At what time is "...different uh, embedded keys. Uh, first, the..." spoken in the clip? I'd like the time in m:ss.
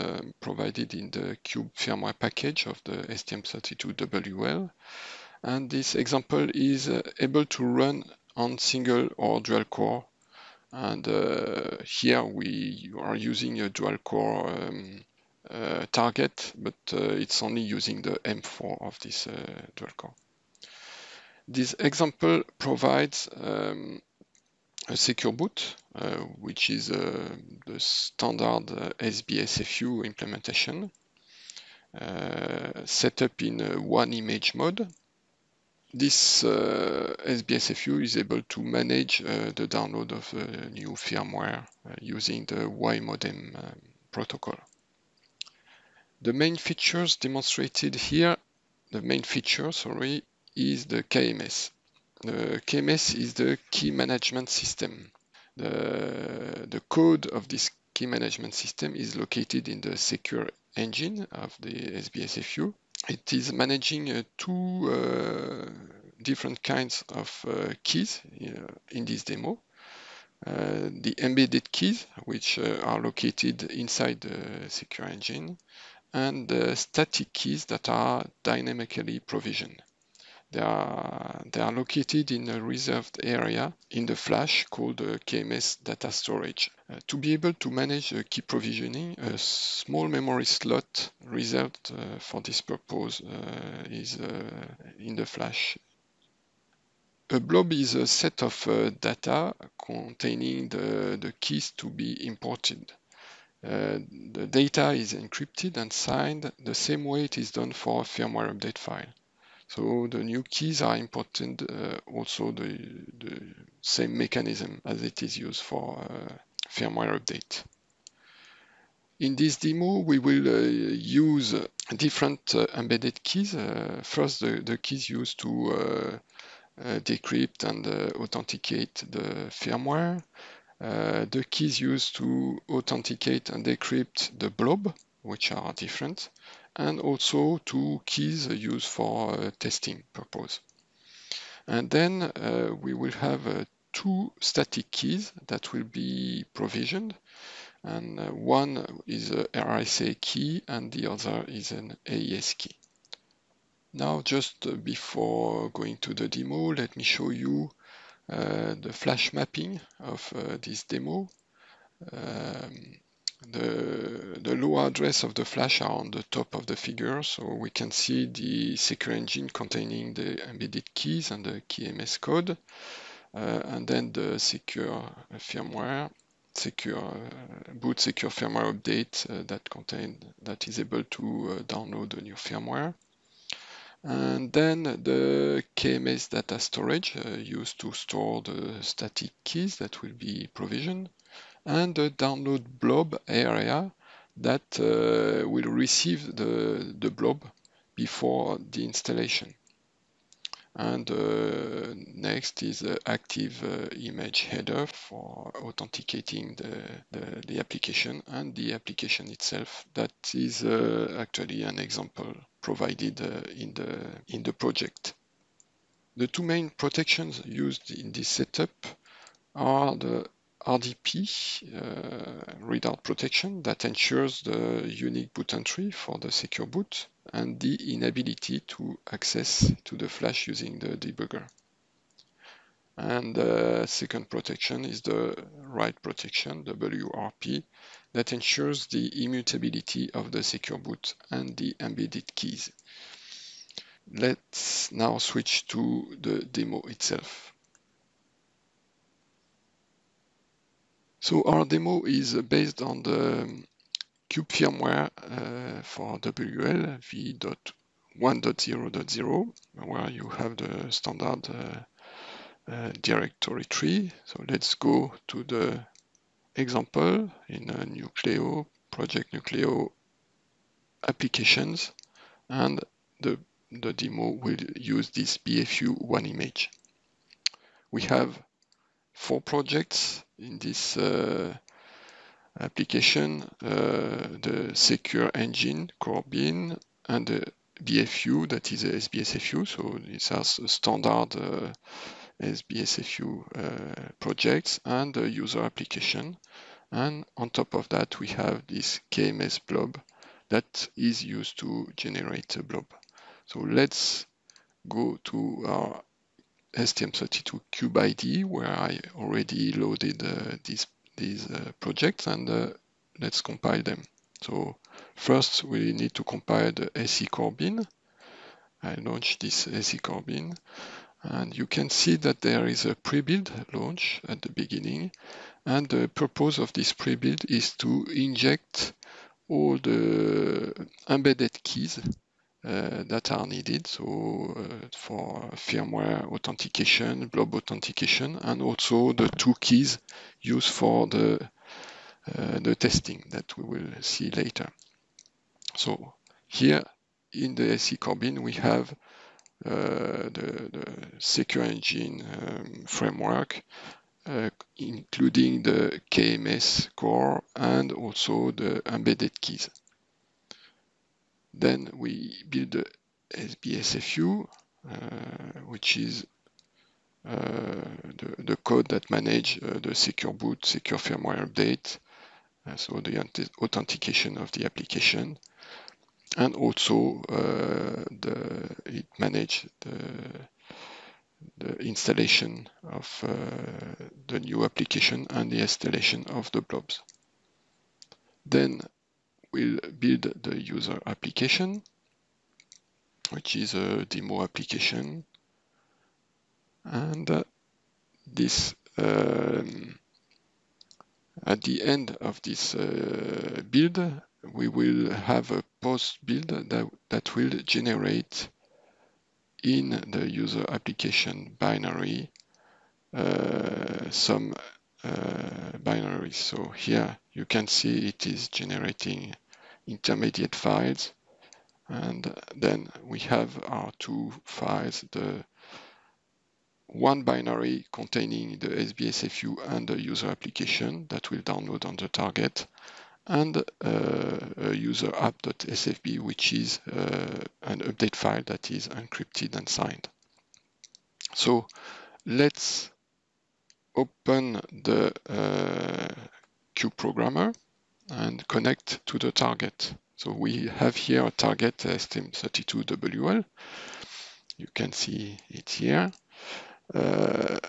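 2:01.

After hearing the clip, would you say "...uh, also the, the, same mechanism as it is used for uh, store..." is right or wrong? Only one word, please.
wrong.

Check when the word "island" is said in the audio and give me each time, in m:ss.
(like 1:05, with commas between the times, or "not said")
not said.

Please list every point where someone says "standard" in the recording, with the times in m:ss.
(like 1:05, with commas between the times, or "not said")
0:27, 4:20, 4:50.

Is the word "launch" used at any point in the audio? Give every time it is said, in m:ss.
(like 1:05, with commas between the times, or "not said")
5:18, 5:23.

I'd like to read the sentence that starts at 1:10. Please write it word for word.
Uh, the embedded keys, which uh, are located inside the secure engine, and the static keys that are dynamically provisioned.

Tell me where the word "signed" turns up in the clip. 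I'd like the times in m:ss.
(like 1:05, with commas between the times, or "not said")
1:45, 7:19.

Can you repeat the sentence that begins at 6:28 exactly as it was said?
Then we'll build the user application, which is a demo application.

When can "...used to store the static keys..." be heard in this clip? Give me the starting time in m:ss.
3:07.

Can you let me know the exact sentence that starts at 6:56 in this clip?
So here you can see it is generating intermediate files.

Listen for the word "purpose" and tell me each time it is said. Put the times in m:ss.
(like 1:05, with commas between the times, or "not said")
1:32, 2:20, 5:26.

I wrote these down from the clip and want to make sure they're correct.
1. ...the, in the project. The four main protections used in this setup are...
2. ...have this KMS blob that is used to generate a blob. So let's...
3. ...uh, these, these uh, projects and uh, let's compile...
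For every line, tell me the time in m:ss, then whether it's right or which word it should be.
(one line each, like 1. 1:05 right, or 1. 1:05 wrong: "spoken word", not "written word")
1. 3:33 wrong: "two", not "four"
2. 4:58 right
3. 5:10 right.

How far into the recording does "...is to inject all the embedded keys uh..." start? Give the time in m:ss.
5:27.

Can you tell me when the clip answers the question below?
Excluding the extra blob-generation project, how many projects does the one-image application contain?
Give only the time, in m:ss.
4:39.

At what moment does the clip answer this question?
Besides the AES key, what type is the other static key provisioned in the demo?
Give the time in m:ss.
2:29.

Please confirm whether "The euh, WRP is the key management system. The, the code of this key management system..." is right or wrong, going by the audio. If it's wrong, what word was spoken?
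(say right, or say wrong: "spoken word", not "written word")
wrong: "KMS", not "WRP".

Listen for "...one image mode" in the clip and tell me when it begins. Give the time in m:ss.
0:33.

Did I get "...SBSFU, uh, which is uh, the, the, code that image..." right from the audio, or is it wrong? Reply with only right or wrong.
wrong.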